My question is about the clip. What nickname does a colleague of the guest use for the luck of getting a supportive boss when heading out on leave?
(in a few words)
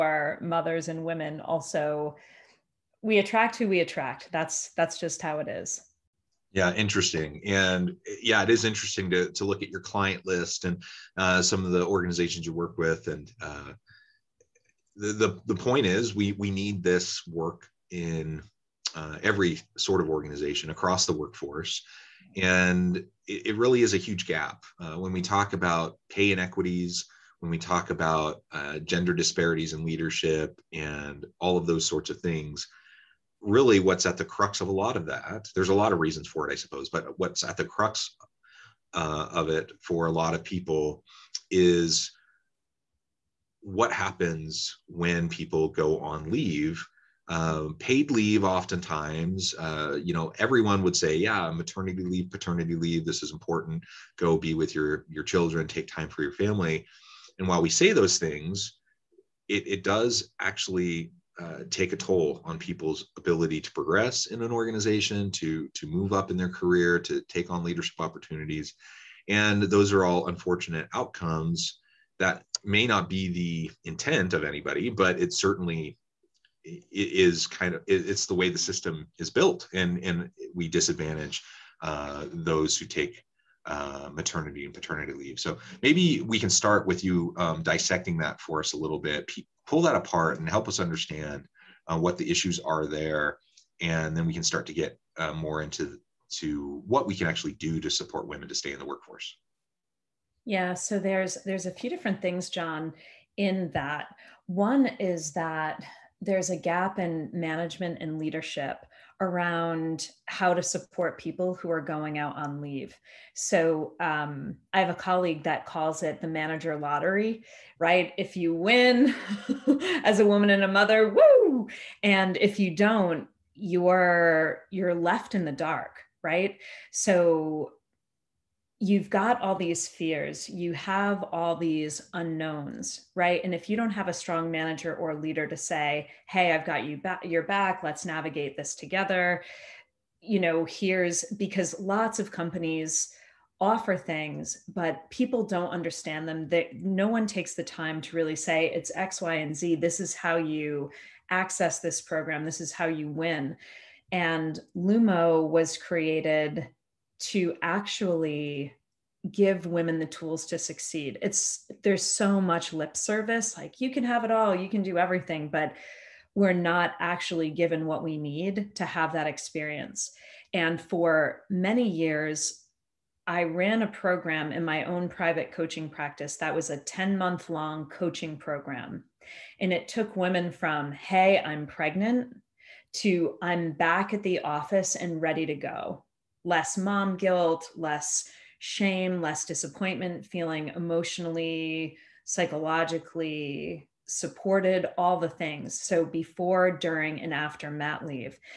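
the manager lottery.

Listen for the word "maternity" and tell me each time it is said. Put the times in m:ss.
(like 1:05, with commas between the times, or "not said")
0:51, 1:24.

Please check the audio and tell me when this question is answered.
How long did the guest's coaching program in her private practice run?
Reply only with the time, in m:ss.
2:56.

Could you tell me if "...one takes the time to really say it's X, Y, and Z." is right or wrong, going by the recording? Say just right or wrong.
right.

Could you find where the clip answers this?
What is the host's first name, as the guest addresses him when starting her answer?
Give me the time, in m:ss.
1:42.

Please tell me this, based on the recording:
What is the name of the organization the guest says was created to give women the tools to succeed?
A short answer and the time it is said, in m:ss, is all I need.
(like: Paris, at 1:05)
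Lumo, at 2:34.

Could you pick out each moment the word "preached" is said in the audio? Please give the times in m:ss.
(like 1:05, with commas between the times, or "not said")
not said.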